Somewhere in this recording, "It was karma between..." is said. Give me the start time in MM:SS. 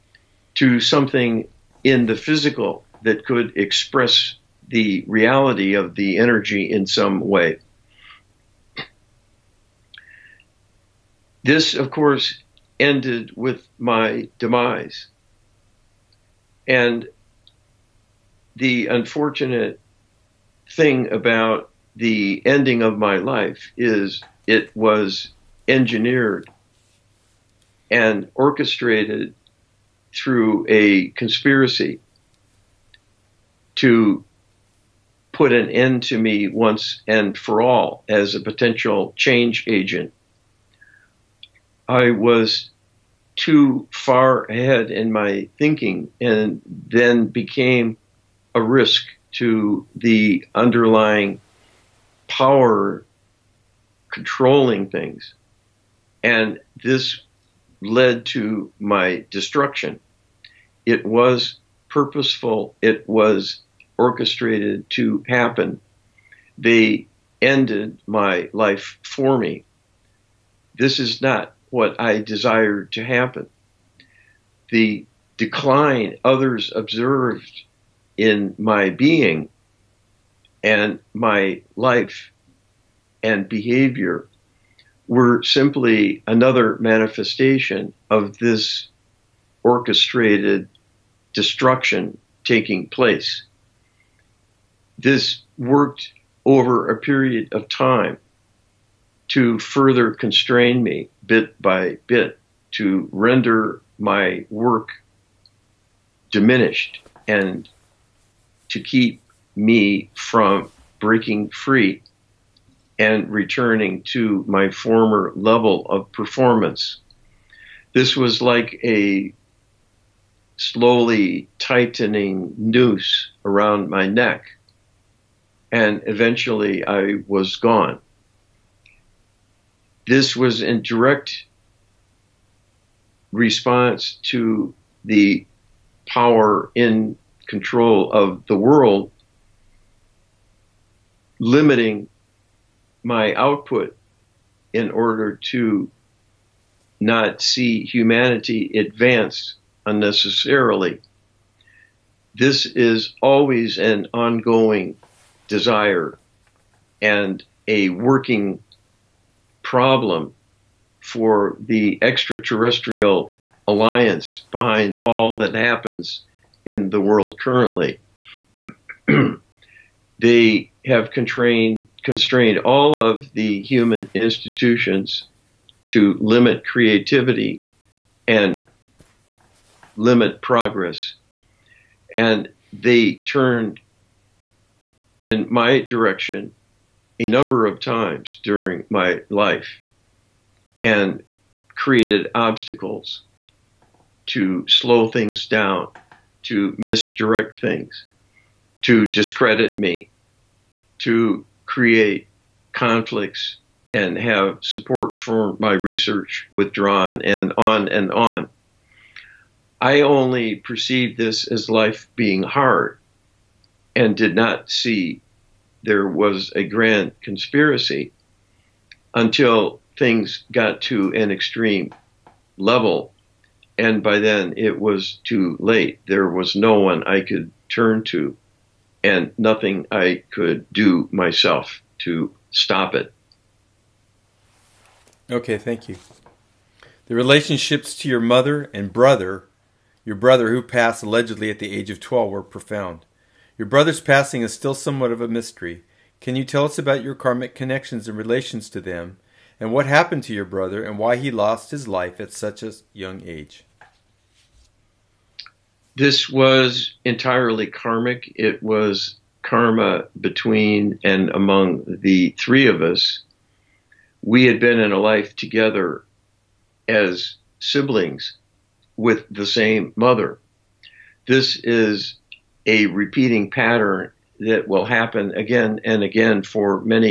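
04:18.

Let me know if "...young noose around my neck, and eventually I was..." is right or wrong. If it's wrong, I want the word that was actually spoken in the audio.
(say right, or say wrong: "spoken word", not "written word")
wrong: "tightening", not "young".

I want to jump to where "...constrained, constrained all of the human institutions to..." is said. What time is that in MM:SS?
02:51.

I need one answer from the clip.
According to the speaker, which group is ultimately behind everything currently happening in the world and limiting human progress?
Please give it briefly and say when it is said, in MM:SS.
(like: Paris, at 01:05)
extraterrestrial alliance, at 02:42.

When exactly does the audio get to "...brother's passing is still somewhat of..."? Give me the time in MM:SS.
04:03.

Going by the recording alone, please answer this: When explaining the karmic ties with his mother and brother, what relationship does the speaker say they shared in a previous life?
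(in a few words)
siblings.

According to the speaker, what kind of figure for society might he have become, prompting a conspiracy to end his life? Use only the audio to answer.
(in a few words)
change agent.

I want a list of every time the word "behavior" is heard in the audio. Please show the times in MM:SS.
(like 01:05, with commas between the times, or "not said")
01:23.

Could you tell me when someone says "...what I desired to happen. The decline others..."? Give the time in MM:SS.
01:11.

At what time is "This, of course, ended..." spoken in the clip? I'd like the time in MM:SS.
00:11.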